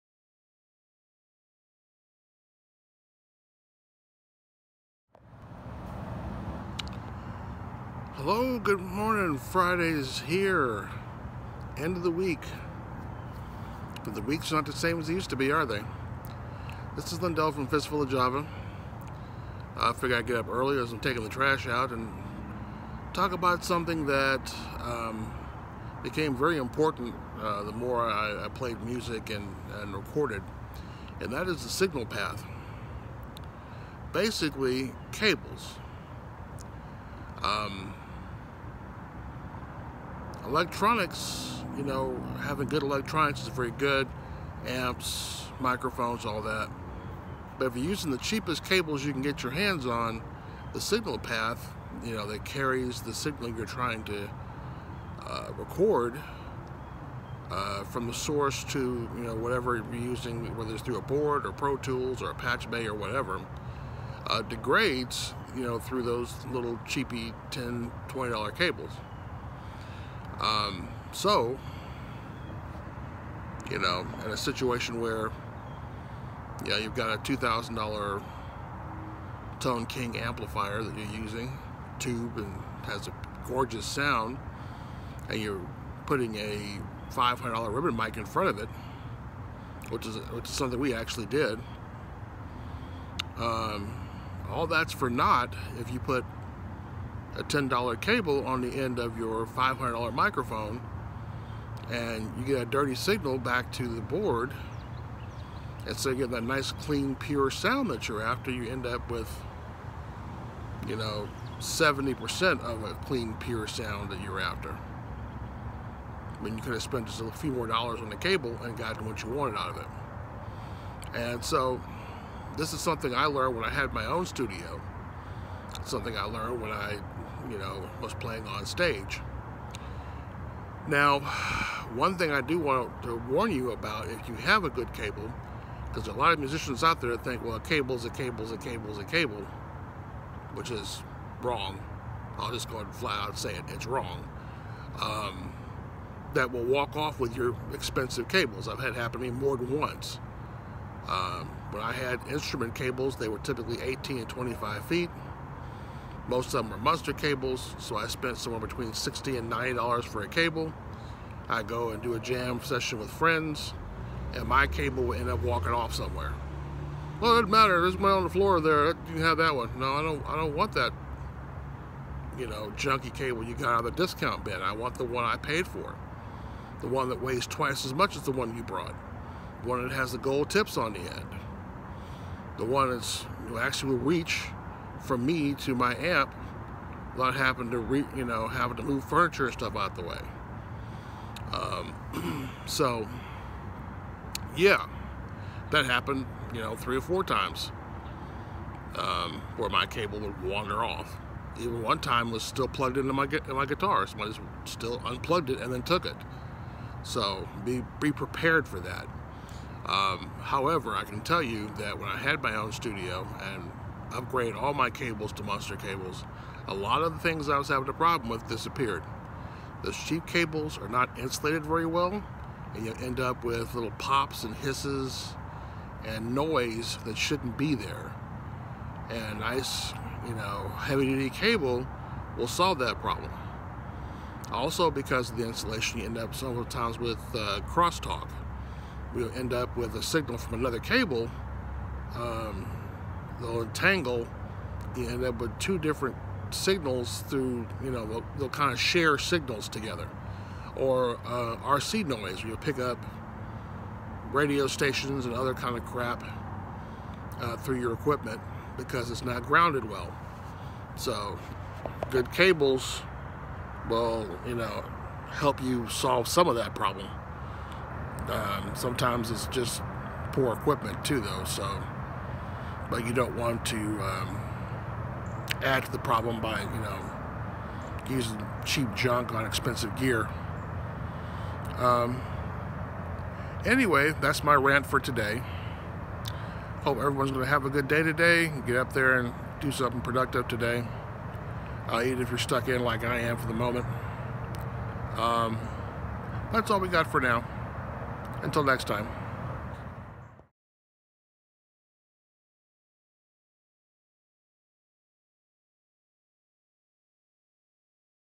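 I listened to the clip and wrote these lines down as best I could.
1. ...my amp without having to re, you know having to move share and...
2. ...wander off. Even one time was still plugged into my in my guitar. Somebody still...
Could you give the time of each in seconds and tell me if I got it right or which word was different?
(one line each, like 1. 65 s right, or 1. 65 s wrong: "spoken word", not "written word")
1. 185 s wrong: "furniture", not "share"
2. 200 s right.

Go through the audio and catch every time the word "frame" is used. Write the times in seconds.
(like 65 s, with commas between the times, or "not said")
not said.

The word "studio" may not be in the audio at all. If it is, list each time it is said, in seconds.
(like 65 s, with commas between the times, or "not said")
124 s, 212 s.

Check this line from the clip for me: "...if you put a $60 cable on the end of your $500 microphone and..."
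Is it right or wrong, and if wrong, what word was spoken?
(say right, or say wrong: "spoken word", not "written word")
wrong: "10", not "60".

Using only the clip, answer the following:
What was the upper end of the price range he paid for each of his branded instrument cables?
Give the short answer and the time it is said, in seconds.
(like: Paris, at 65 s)
$90, at 159 s.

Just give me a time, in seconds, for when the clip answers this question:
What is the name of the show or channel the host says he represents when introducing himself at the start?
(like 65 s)
17 s.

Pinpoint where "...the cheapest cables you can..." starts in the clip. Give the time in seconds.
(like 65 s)
48 s.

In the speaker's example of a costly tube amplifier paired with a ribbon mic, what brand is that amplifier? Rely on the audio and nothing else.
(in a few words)
Tone King.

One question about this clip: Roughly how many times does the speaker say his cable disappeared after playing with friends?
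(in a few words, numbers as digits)
3 or 4 times.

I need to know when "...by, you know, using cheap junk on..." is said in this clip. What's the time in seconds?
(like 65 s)
276 s.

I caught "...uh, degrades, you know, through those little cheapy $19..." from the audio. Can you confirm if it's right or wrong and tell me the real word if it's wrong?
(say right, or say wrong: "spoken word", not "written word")
wrong: "10", not "19".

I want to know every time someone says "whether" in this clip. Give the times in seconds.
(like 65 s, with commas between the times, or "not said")
60 s.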